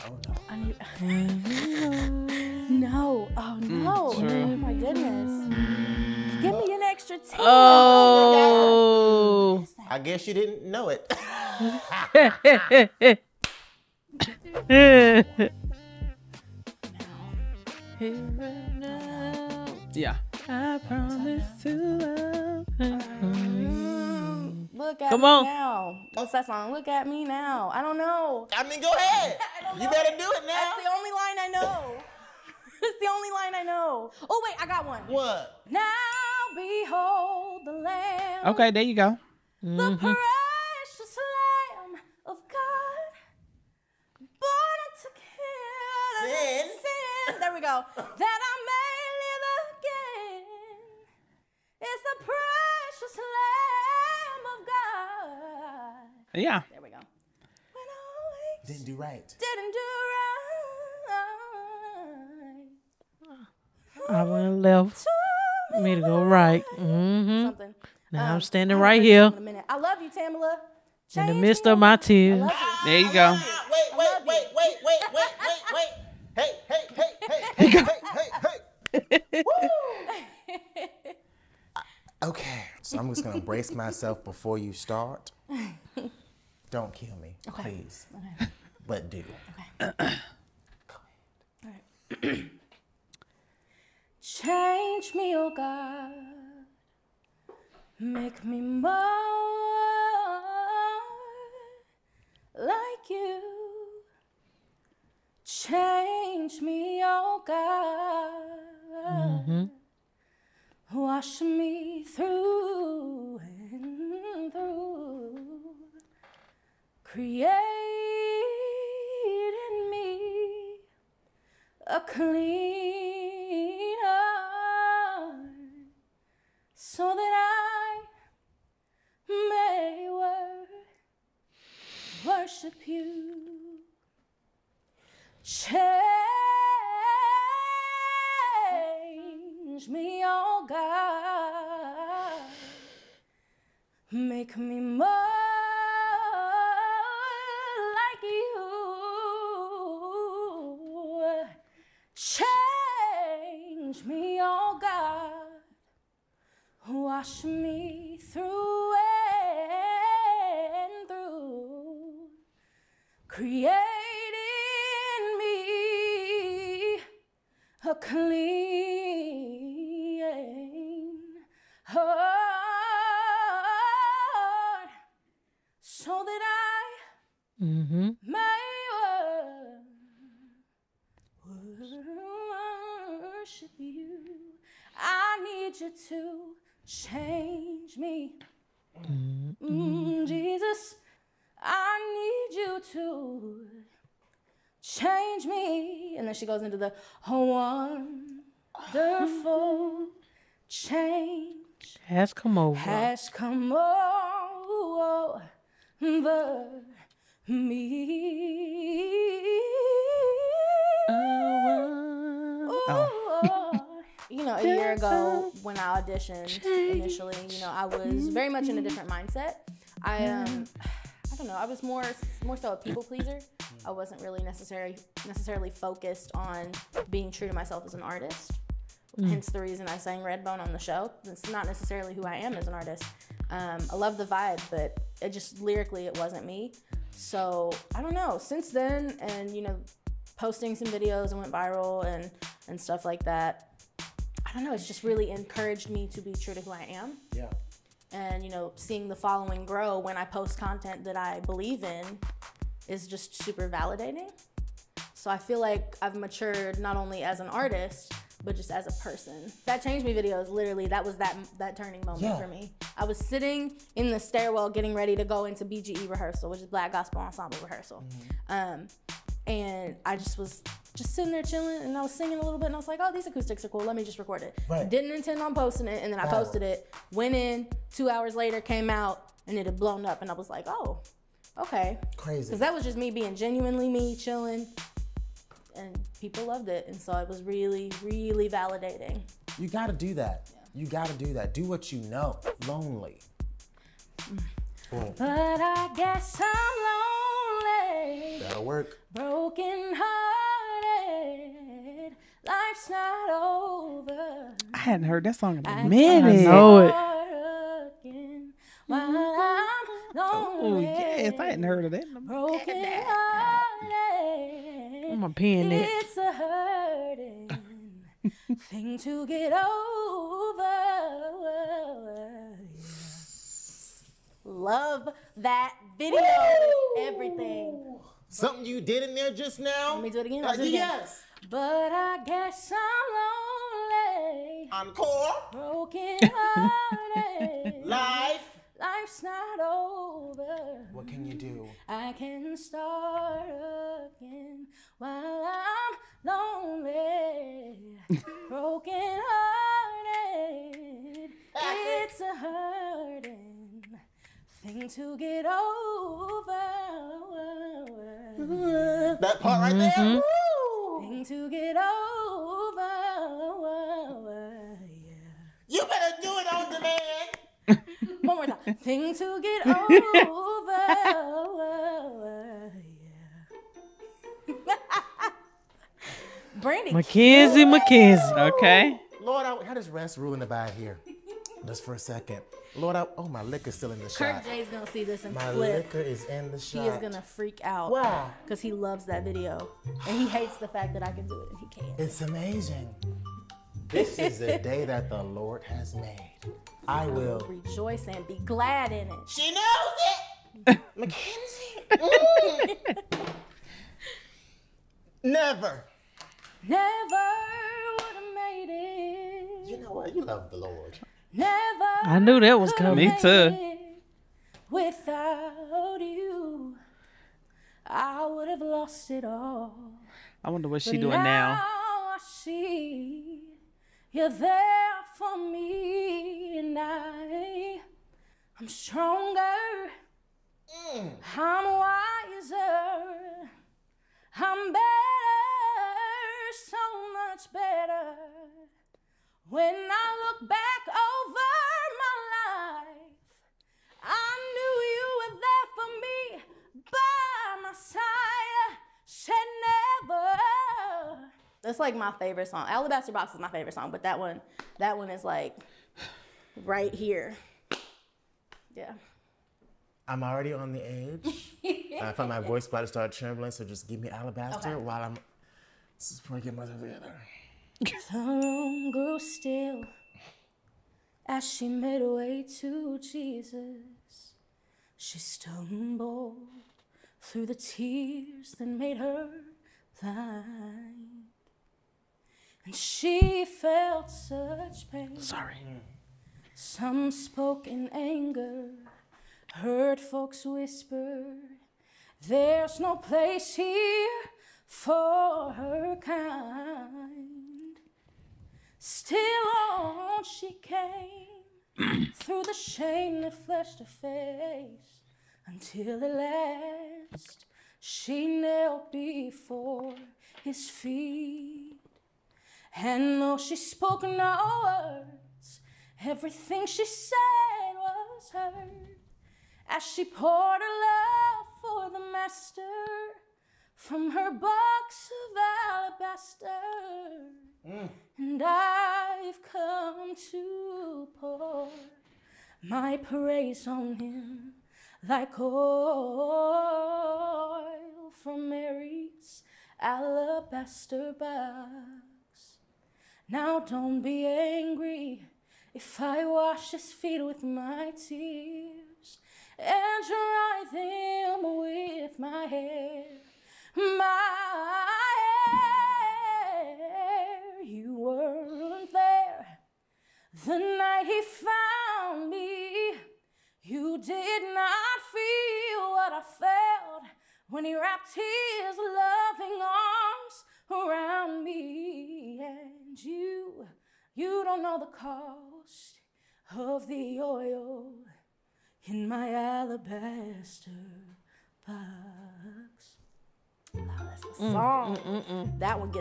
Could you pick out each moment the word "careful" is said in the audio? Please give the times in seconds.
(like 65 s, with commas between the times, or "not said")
not said.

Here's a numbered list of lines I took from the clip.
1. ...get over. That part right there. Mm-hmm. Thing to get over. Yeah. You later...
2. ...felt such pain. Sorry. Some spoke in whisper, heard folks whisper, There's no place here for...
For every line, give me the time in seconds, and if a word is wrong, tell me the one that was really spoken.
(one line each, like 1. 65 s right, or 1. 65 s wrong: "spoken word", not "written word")
1. 355 s wrong: "better", not "later"
2. 483 s wrong: "anger", not "whisper".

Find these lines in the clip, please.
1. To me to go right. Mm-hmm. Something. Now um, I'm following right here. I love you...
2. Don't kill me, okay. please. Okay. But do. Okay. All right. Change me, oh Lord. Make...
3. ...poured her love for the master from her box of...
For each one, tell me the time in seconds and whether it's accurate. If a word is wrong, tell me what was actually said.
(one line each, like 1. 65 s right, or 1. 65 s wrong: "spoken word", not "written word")
1. 65 s wrong: "standing", not "following"
2. 86 s wrong: "God", not "Lord"
3. 520 s right.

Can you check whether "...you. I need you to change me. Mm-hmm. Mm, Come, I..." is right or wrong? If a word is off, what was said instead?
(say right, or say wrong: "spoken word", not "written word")
wrong: "Jesus", not "Come".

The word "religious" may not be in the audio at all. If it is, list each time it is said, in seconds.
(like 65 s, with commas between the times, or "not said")
not said.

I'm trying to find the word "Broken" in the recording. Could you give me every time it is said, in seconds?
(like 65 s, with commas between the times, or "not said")
299 s, 312 s, 335 s, 348 s.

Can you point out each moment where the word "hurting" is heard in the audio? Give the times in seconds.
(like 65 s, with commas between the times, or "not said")
316 s, 352 s.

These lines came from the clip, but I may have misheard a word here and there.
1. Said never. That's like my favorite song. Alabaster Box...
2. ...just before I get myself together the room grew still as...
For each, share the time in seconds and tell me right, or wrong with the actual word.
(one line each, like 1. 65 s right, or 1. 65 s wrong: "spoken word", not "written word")
1. 449 s right
2. 465 s right.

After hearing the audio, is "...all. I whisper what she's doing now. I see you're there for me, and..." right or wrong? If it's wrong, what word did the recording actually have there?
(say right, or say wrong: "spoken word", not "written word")
wrong: "wonder", not "whisper".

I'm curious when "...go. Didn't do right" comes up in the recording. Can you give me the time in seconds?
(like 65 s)
56 s.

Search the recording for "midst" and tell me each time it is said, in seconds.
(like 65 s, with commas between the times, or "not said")
71 s.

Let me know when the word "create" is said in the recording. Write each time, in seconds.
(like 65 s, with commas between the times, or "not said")
117 s, 163 s.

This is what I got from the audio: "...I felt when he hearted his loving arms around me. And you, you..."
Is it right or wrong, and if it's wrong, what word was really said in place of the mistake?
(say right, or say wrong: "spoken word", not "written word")
wrong: "wrapped", not "hearted".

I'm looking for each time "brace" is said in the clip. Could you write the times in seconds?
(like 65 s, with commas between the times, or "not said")
83 s.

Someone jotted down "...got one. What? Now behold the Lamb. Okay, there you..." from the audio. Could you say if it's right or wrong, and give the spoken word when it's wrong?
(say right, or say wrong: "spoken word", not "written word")
right.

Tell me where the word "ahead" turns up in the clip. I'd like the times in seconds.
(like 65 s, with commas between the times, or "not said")
28 s.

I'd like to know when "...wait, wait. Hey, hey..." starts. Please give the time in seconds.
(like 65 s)
75 s.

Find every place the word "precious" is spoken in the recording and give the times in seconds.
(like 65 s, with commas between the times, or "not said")
39 s, 52 s.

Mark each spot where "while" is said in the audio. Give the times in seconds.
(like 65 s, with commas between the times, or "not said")
344 s, 464 s.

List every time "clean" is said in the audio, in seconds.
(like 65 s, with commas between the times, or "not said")
122 s, 167 s.